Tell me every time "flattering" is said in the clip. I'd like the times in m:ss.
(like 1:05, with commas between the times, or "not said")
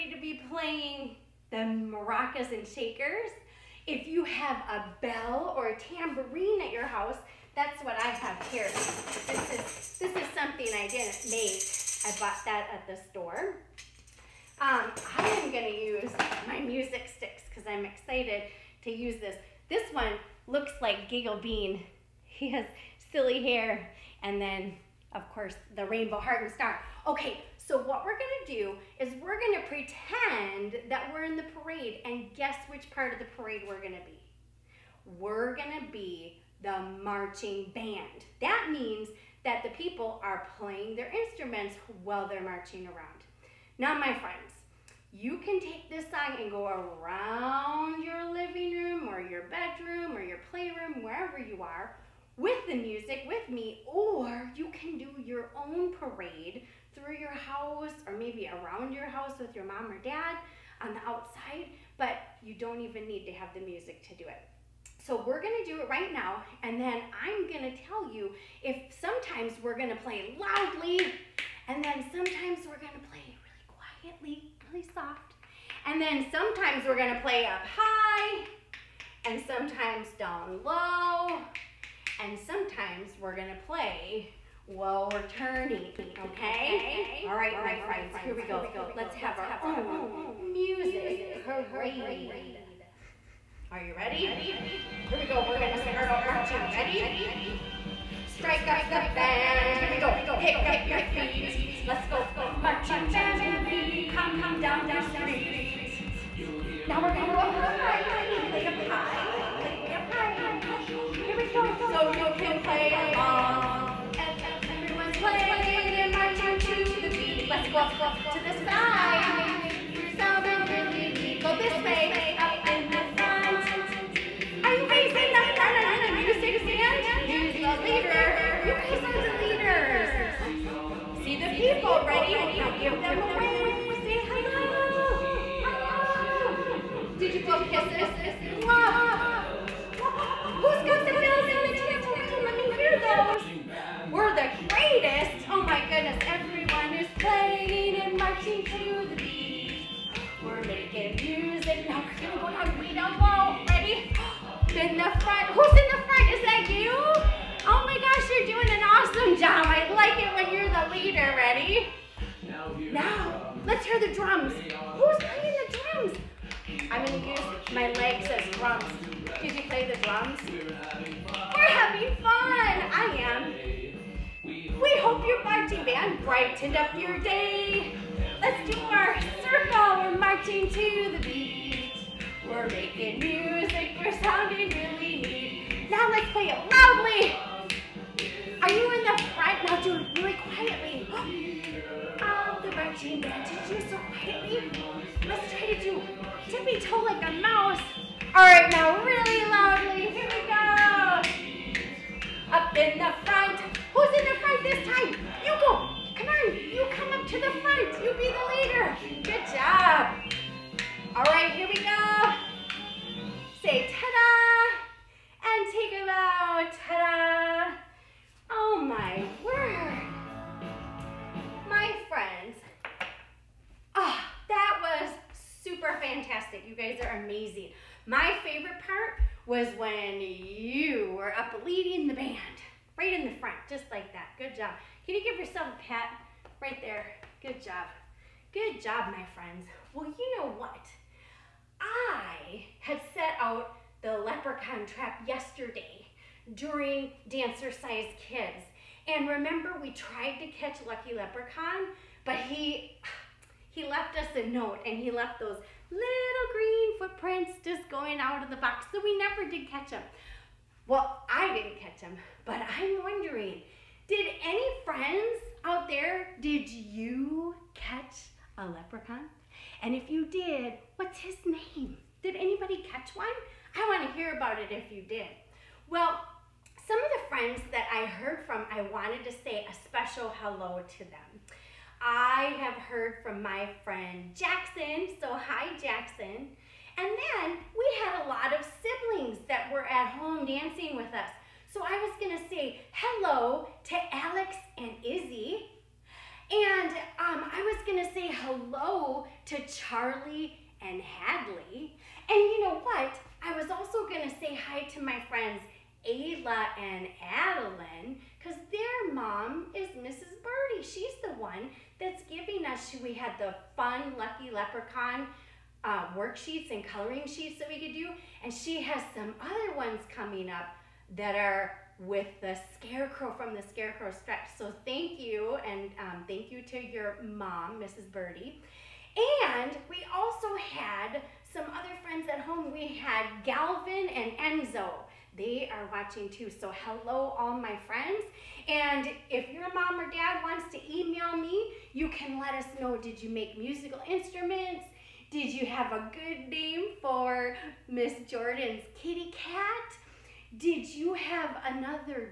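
not said.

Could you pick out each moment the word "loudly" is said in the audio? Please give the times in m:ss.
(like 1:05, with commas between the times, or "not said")
1:10, 3:06, 3:19.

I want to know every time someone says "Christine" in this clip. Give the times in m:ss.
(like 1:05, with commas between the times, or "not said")
not said.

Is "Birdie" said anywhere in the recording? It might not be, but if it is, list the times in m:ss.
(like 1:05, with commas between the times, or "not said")
5:10, 5:28.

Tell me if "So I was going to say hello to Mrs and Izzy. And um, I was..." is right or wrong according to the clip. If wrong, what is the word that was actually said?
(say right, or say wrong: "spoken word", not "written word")
wrong: "Alex", not "Mrs".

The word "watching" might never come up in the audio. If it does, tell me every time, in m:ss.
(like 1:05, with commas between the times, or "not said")
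5:35.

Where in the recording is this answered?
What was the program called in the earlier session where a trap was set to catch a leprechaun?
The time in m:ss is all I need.
4:07.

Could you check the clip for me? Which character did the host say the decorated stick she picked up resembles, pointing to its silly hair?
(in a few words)
Giggle Bean.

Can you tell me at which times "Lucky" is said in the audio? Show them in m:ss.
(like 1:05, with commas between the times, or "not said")
4:10, 5:14.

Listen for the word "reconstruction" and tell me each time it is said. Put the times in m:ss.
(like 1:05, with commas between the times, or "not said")
not said.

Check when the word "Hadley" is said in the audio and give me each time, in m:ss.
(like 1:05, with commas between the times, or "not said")
5:00.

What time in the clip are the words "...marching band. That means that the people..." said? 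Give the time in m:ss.
0:37.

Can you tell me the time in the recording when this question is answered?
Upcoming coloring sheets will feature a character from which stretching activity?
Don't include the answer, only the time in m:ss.
5:23.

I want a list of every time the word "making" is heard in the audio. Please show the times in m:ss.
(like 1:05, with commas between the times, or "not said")
2:30, 3:02.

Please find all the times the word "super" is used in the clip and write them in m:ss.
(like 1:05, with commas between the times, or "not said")
3:45.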